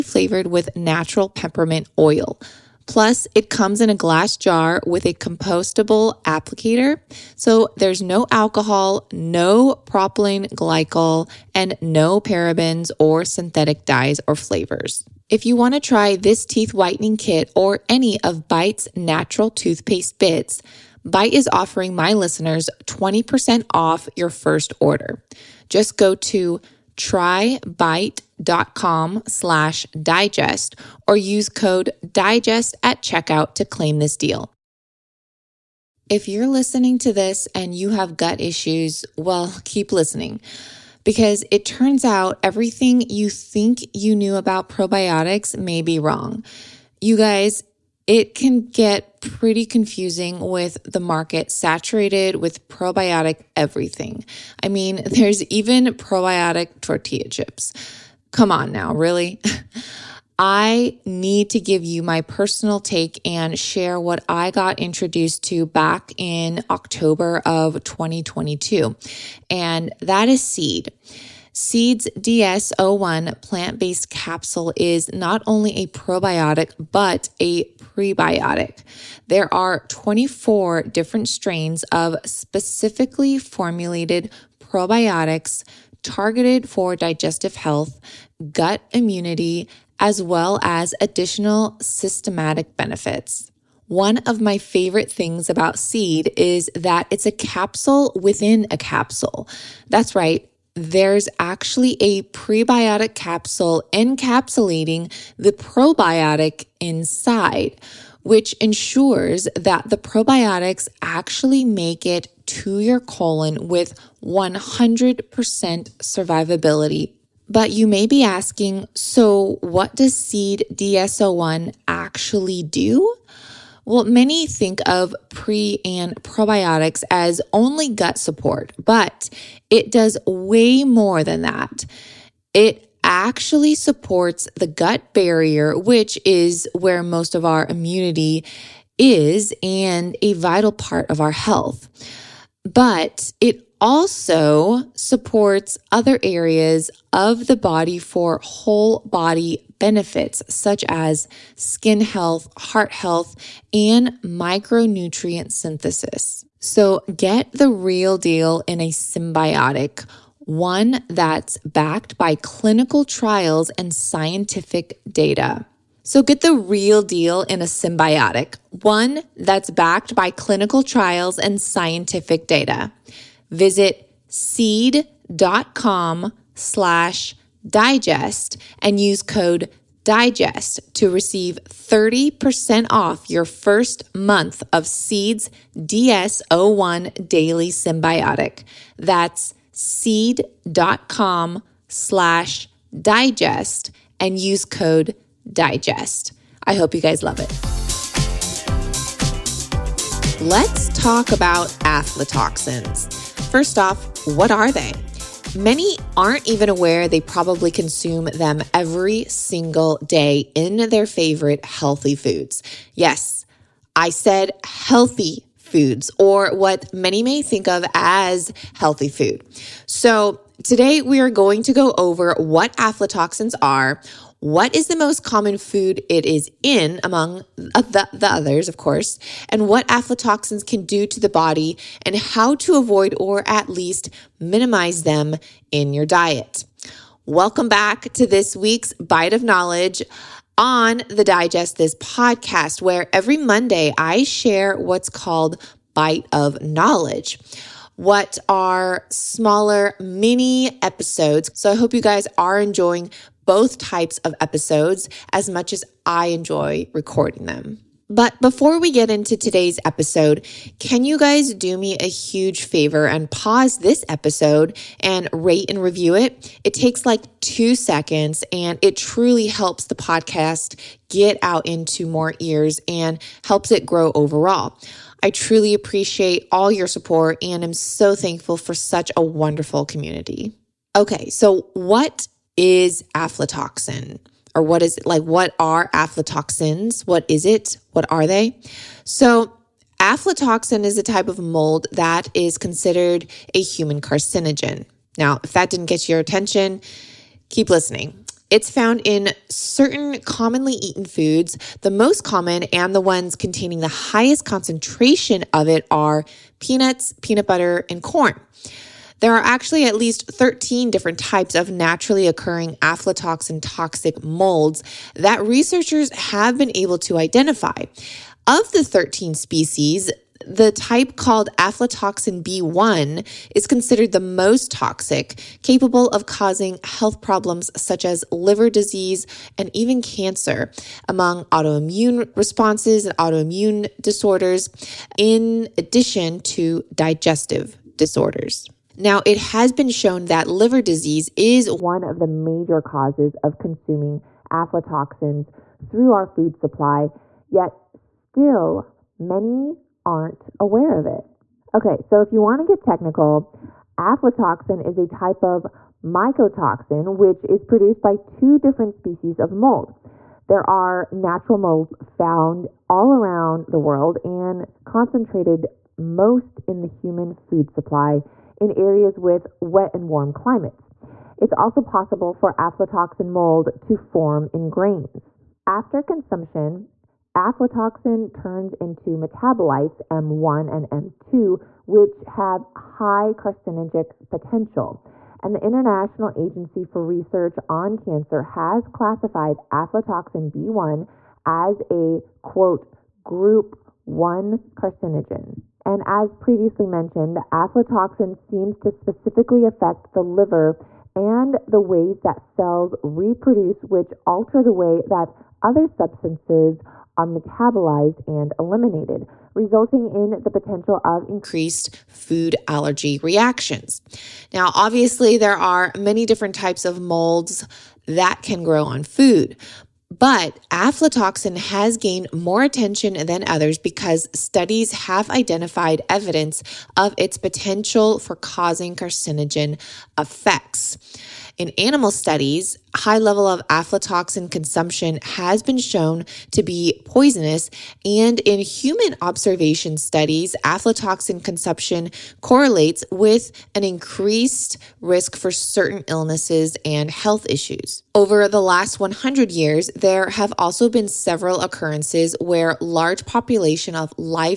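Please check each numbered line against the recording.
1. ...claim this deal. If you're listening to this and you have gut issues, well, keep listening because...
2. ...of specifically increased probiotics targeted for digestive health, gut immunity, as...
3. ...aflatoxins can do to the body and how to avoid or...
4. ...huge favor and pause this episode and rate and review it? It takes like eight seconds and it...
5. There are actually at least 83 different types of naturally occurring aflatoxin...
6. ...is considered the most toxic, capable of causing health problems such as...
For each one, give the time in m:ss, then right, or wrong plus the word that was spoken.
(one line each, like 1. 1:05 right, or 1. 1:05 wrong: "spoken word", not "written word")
1. 0:33 right
2. 1:21 wrong: "formulated", not "increased"
3. 3:49 right
4. 4:22 wrong: "two", not "eight"
5. 5:09 wrong: "13", not "83"
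6. 5:23 right.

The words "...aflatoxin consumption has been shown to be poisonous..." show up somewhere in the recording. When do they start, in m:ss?
7:13.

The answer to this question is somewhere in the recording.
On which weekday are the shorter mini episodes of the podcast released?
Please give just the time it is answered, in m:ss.
4:03.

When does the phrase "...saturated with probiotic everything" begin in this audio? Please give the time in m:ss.
0:51.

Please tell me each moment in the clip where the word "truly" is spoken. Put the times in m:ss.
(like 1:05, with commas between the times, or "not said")
4:28, 4:35.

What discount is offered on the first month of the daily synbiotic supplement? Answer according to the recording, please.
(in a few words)
30%.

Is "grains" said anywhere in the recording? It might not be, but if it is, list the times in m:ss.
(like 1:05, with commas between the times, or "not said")
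6:14.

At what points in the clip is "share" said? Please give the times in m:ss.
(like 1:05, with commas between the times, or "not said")
1:03, 4:04.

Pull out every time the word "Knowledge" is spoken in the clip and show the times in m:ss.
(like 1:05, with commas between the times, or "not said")
3:59, 4:06.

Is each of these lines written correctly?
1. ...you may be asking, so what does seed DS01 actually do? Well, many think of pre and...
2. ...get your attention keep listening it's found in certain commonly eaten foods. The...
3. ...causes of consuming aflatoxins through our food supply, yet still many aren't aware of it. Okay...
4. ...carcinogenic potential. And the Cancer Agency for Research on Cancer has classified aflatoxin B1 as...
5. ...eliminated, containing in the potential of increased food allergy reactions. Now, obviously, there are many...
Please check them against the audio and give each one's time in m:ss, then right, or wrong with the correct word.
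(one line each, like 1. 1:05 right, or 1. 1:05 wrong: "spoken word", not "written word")
1. 1:57 right
2. 4:55 right
3. 5:42 right
4. 6:23 wrong: "International", not "Cancer"
5. 6:48 wrong: "resulting", not "containing".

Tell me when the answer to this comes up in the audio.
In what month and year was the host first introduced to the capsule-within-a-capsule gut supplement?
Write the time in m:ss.
1:06.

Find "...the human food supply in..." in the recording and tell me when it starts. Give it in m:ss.
6:06.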